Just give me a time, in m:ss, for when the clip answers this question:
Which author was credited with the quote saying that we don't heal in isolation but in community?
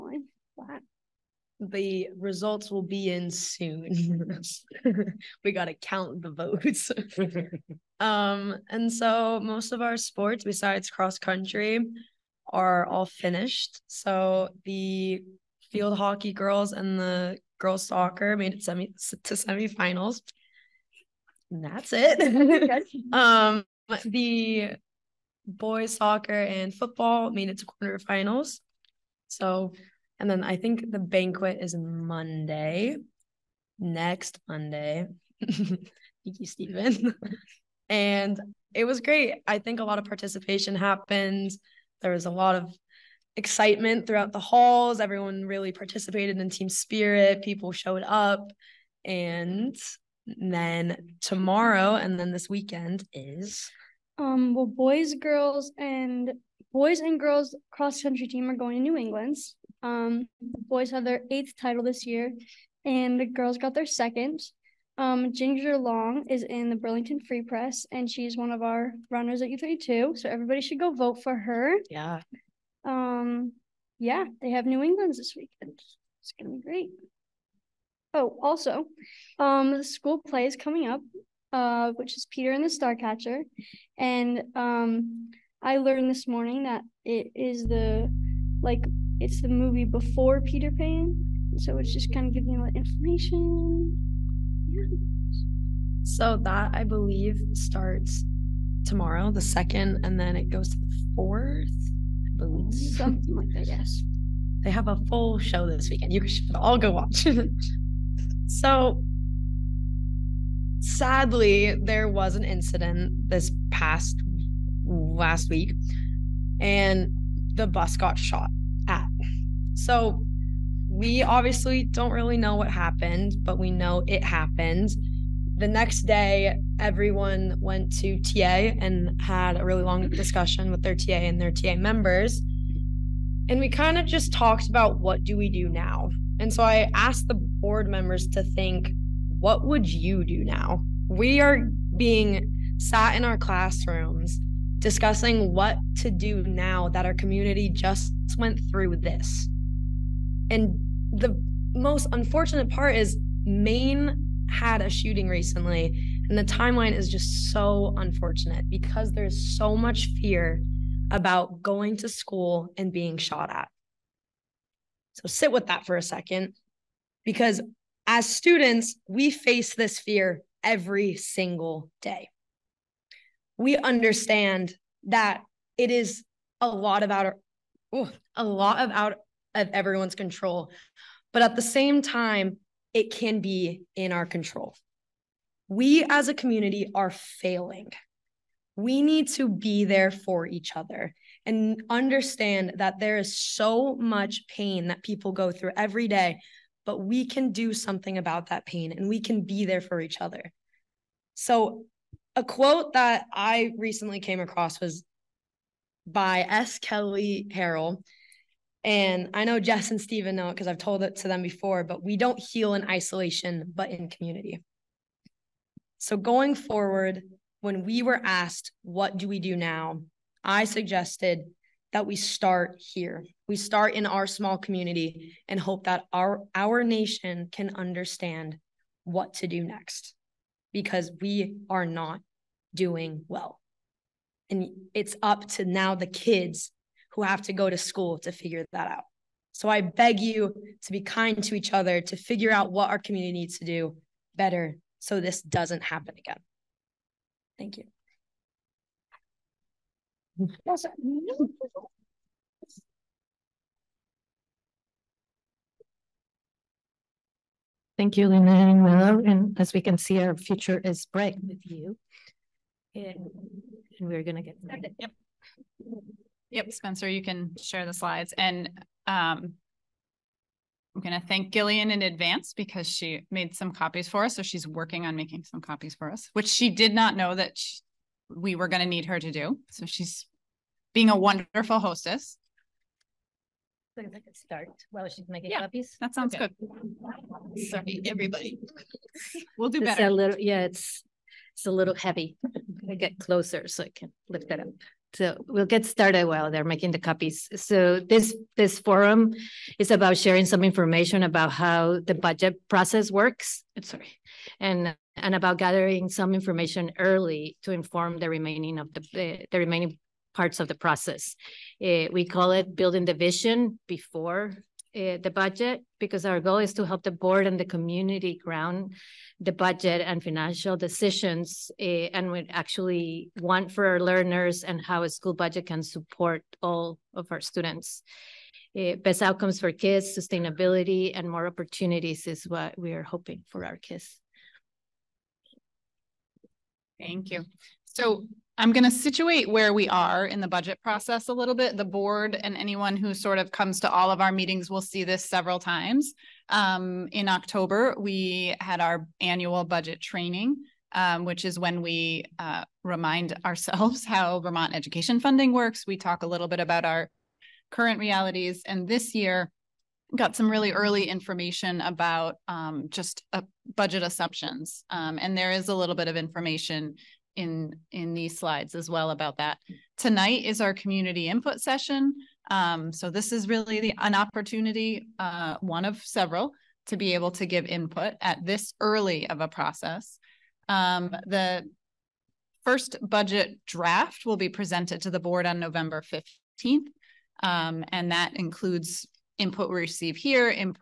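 3:26.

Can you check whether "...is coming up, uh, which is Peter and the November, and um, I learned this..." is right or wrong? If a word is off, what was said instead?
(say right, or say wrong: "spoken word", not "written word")
wrong: "Starcatcher", not "November".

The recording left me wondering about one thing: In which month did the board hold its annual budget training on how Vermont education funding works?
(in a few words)
October.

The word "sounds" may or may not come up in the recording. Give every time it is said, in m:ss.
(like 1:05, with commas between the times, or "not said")
4:46.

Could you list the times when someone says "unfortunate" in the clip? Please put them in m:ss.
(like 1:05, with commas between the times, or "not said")
2:32, 2:37.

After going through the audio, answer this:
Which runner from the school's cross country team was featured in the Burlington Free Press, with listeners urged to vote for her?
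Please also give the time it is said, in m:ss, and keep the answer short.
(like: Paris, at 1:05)
Ginger Long, at 1:05.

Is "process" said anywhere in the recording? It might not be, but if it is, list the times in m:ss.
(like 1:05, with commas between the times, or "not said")
5:02, 5:10, 5:40, 6:19.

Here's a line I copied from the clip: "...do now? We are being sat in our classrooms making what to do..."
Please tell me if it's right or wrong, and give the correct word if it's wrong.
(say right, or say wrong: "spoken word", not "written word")
wrong: "discussing", not "making".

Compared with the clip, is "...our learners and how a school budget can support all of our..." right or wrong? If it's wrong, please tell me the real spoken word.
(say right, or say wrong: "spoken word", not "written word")
right.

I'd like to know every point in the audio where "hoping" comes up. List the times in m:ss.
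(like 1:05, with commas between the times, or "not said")
5:33.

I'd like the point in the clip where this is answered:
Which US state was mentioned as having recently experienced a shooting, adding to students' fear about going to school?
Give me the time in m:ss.
2:33.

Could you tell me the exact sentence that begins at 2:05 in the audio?
The next day, everyone went to TA and had a really long discussion with their TA and their TA members.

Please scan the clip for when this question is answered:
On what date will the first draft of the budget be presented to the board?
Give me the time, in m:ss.
6:25.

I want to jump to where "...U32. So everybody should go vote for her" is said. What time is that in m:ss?
1:09.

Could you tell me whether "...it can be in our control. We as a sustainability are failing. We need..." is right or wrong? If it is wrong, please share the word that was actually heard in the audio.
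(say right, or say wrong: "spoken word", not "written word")
wrong: "community", not "sustainability".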